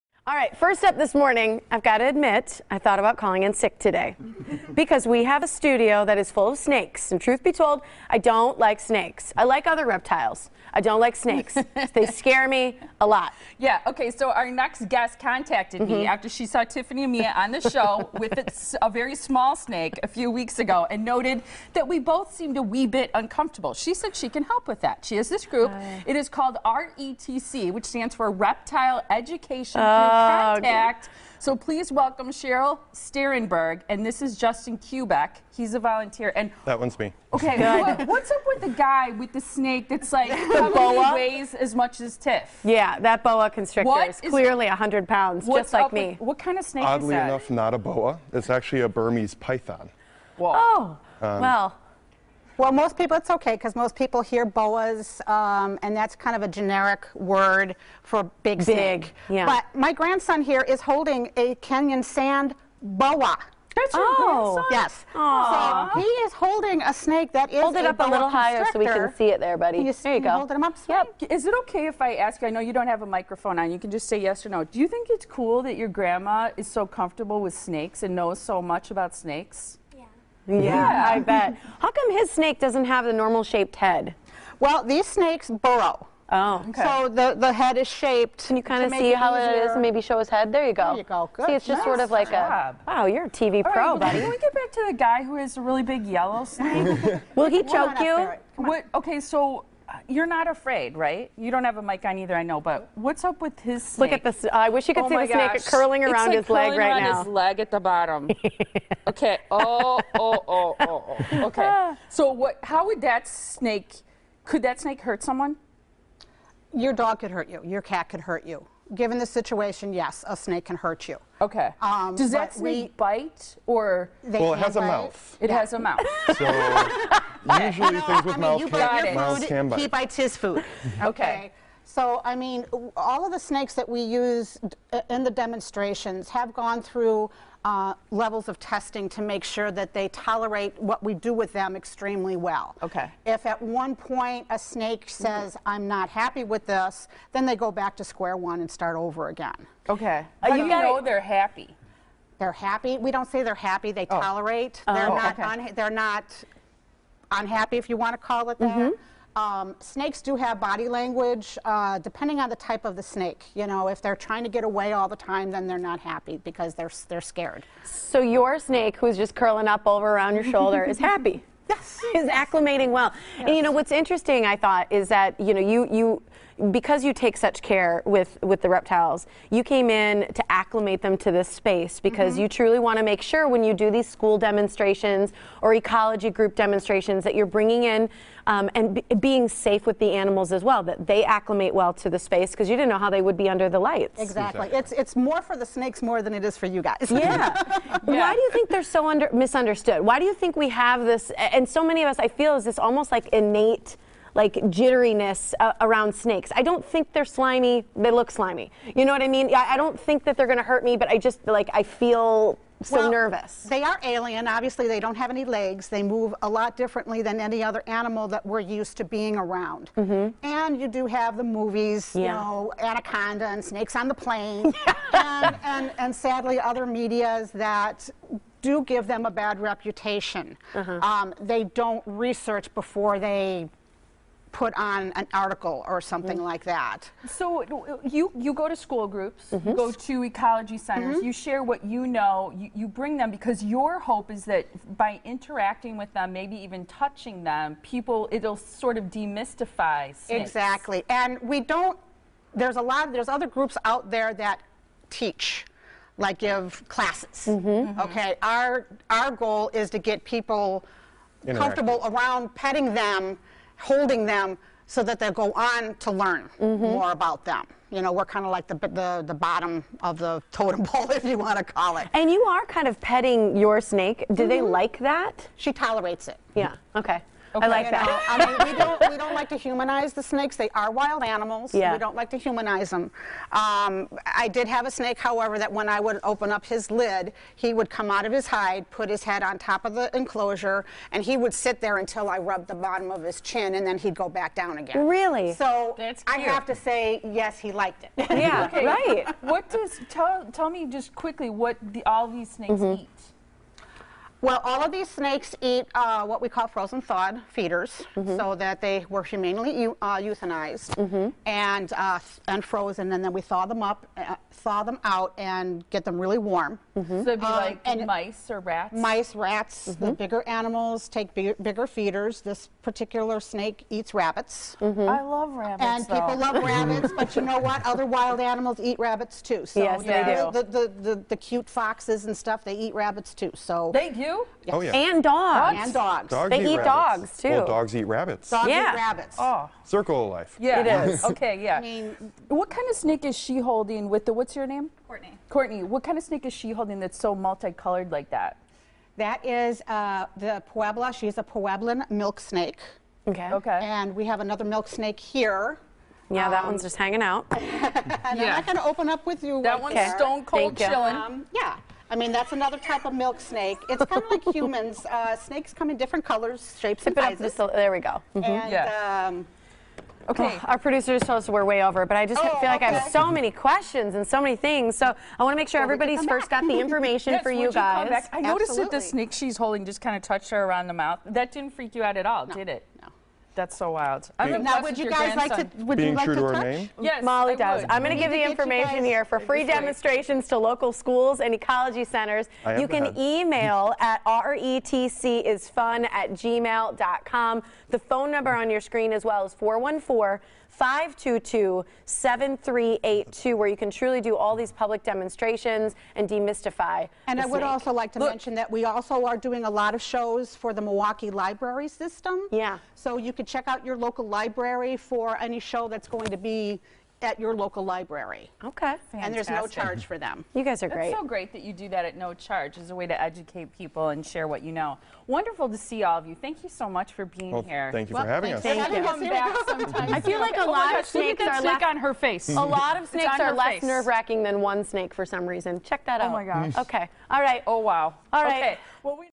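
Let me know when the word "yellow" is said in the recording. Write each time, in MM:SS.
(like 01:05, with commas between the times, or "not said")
01:36.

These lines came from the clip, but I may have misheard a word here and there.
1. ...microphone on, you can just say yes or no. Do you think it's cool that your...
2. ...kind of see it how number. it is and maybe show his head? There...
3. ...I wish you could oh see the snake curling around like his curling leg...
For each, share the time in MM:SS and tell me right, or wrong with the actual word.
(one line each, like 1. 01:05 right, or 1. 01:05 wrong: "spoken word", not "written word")
1. 01:13 right
2. 01:28 wrong: "easier", not "number"
3. 01:44 right.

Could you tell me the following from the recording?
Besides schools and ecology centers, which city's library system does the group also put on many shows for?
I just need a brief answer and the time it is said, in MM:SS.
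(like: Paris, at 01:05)
Milwaukee, at 06:50.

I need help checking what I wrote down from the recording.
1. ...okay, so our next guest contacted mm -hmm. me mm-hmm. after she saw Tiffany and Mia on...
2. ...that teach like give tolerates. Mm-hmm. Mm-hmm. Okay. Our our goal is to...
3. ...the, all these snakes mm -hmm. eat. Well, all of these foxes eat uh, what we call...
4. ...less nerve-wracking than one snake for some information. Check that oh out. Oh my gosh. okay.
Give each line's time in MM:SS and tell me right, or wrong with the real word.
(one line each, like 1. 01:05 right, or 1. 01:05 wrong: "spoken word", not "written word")
1. 00:13 right
2. 04:14 wrong: "classes", not "tolerates"
3. 05:01 wrong: "snakes", not "foxes"
4. 07:13 wrong: "reason", not "information".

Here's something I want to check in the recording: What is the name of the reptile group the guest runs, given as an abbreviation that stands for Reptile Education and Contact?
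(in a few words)
RETC.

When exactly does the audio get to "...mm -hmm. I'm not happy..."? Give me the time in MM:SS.
02:25.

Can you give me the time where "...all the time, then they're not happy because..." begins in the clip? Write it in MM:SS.
02:44.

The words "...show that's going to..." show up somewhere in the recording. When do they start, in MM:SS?
06:55.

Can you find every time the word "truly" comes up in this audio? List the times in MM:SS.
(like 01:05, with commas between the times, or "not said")
03:02, 06:43.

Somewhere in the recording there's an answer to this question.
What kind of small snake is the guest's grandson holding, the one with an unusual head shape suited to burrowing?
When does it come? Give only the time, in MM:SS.
01:01.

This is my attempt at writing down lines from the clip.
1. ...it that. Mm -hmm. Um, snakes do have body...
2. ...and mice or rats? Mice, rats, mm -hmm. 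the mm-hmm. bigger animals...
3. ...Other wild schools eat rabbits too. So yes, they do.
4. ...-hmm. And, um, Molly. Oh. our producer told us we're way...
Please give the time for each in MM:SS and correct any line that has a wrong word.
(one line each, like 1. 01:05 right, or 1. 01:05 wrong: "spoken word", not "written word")
1. 02:38 right
2. 05:17 right
3. 05:27 wrong: "animals", not "schools"
4. 06:08 wrong: "Okay", not "Molly".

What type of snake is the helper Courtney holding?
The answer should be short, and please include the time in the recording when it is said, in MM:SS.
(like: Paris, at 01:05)
Pueblan milk snake, at 05:51.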